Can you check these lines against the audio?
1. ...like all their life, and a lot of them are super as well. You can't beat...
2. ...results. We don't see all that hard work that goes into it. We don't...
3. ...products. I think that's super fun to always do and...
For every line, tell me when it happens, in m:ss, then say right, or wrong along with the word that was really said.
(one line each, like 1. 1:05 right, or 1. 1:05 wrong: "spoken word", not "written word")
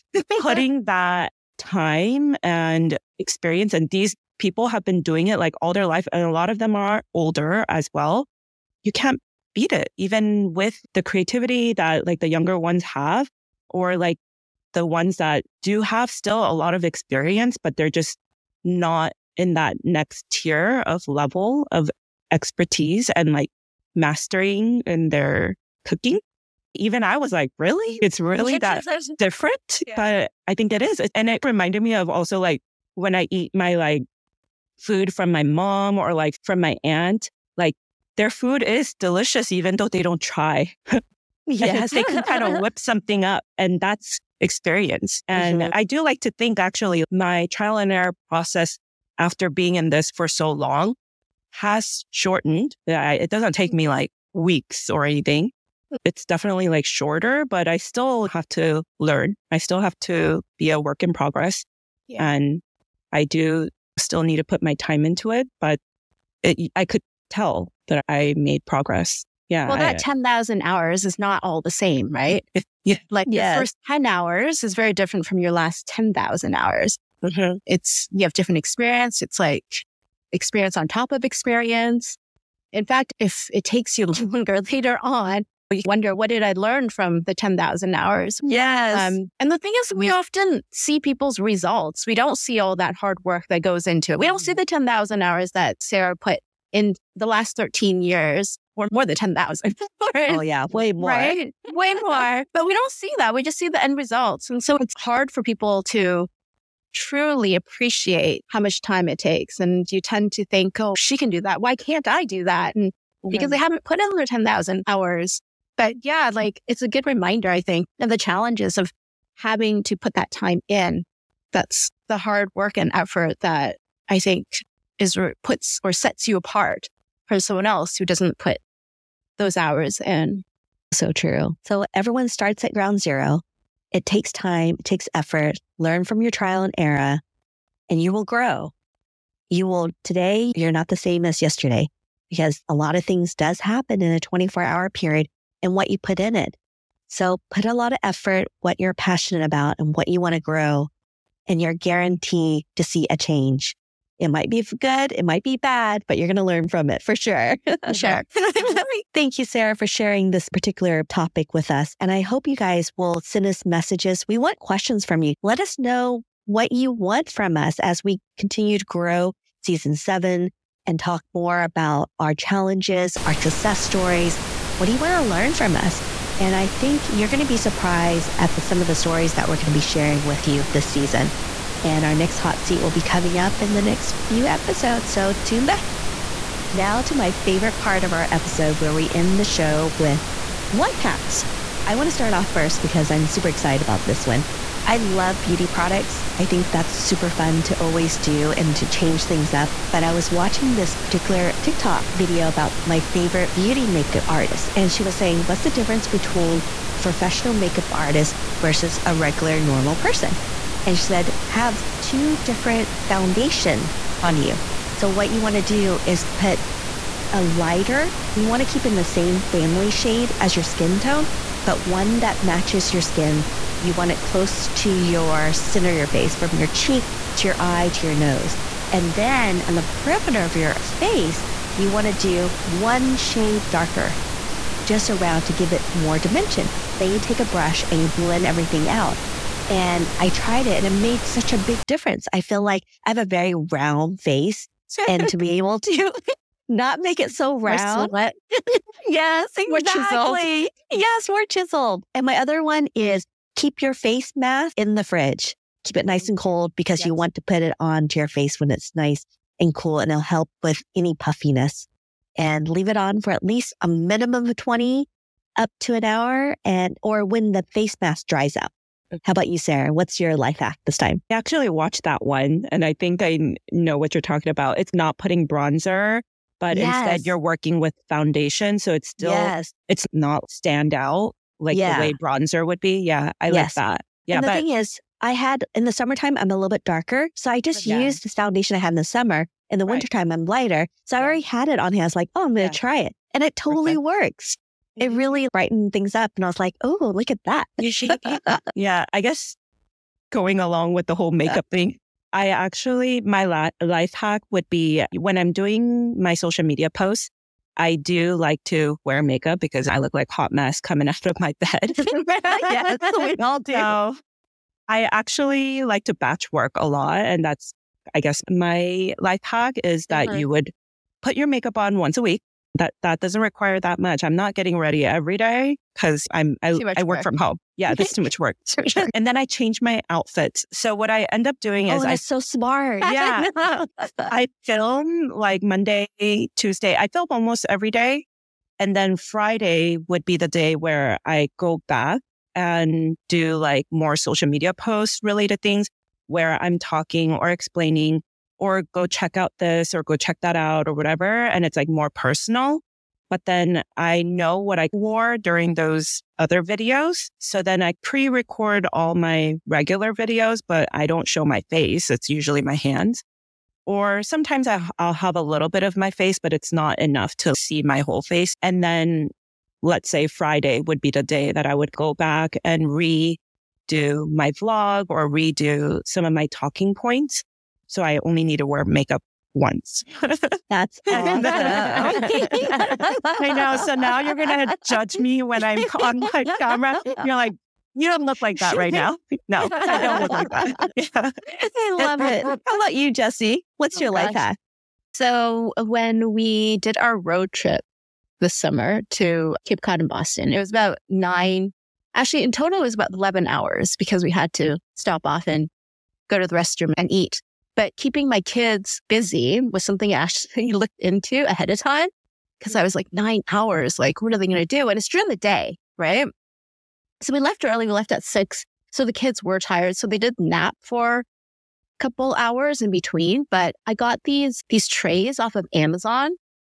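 1. 0:05 wrong: "older", not "super"
2. 1:31 right
3. 3:15 right.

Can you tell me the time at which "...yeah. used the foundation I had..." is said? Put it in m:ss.
4:47.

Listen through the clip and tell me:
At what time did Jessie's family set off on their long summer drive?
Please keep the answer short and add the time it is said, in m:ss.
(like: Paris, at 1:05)
6, at 6:58.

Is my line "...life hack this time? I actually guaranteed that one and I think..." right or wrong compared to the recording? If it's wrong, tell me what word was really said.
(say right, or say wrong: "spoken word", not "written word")
wrong: "watched", not "guaranteed".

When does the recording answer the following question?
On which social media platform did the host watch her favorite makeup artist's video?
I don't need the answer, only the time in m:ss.
3:21.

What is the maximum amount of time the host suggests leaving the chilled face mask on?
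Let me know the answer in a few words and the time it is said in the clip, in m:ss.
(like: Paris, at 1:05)
an hour, at 4:25.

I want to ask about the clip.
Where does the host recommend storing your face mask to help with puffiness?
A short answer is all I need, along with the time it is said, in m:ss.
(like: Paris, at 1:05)
the fridge, at 4:15.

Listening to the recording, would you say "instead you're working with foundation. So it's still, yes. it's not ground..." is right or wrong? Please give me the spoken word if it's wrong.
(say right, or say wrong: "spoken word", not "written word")
wrong: "stand", not "ground".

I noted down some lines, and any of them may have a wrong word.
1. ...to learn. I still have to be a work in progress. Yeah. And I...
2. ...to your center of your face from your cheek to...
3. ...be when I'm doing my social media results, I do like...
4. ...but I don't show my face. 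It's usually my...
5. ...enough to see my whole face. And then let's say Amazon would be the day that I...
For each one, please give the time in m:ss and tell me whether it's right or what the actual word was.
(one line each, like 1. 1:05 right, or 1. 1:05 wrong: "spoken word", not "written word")
1. 0:58 right
2. 3:44 right
3. 5:04 wrong: "posts", not "results"
4. 6:00 right
5. 6:06 wrong: "Friday", not "Amazon".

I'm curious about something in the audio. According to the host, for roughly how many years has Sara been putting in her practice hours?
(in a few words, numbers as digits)
13.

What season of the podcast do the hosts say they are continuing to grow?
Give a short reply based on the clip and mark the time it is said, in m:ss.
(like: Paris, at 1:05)
season 7, at 2:49.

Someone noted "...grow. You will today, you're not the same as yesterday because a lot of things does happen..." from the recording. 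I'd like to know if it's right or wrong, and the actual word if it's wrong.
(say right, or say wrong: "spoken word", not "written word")
right.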